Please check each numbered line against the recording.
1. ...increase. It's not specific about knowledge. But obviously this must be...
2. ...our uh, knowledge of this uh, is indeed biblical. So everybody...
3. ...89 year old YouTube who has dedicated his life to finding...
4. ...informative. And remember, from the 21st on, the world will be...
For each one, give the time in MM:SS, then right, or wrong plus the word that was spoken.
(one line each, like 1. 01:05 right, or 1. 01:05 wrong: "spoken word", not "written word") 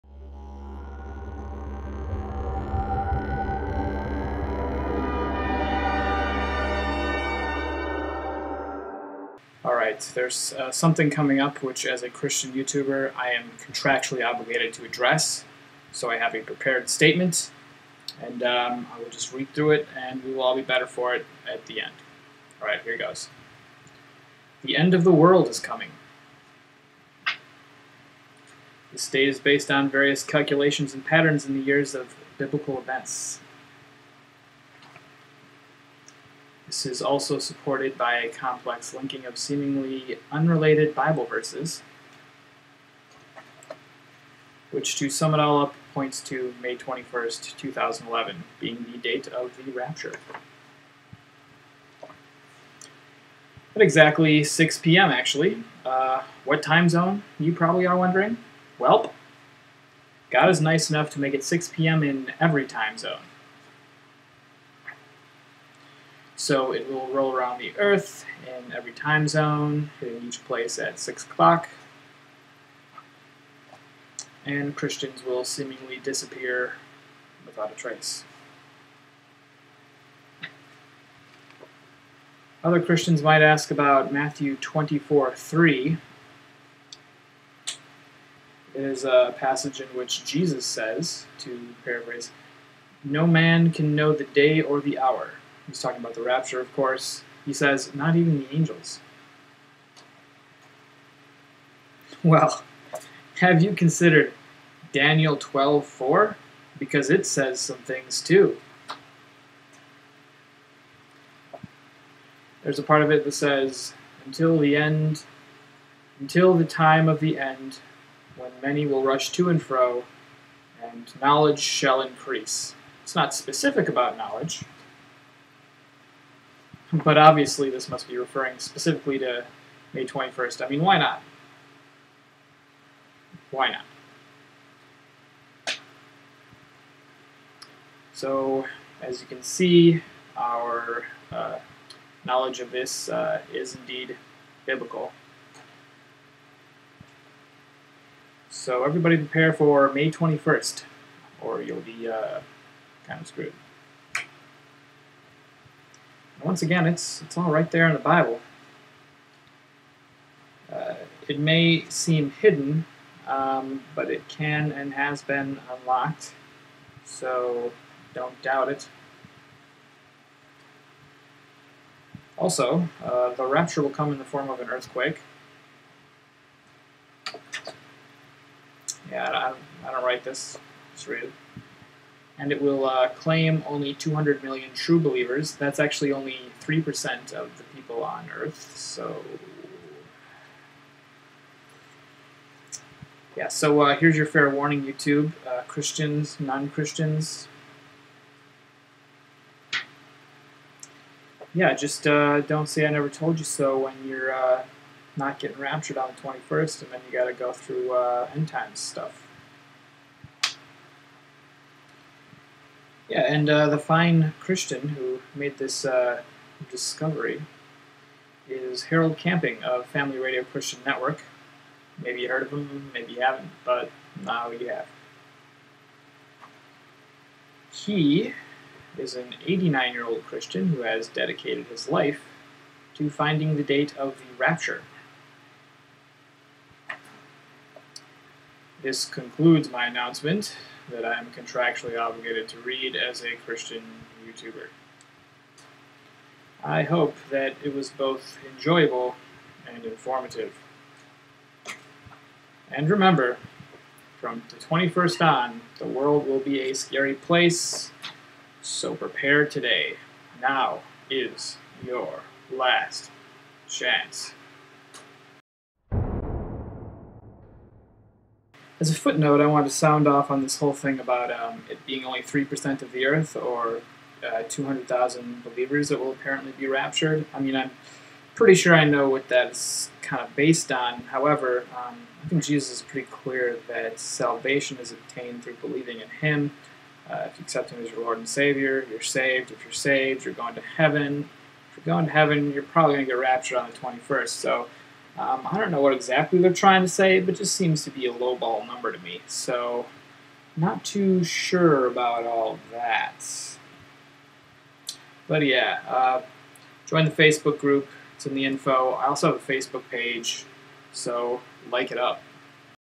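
1. 02:02 right
2. 02:20 right
3. 03:49 wrong: "Christian", not "YouTube"
4. 04:09 right.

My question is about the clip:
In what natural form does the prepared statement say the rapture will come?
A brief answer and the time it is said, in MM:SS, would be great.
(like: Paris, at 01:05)
an earthquake, at 02:54.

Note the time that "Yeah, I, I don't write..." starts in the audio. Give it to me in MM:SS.
02:59.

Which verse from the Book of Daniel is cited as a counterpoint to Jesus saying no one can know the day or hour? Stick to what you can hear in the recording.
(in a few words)
Daniel 12:4.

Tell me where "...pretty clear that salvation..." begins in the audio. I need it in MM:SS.
04:42.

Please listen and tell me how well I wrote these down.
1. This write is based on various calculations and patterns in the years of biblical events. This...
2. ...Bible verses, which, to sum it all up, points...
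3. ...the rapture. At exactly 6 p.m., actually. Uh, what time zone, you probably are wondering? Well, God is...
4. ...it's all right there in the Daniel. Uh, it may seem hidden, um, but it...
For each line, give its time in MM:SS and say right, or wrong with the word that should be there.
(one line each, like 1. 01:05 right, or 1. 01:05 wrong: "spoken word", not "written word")
1. 00:28 wrong: "state", not "write"
2. 00:40 right
3. 00:49 right
4. 02:37 wrong: "Bible", not "Daniel".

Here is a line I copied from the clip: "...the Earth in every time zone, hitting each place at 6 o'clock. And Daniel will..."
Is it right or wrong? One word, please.
wrong.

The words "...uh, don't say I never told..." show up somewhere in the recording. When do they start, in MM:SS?
03:22.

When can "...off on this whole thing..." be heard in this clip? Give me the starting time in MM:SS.
04:30.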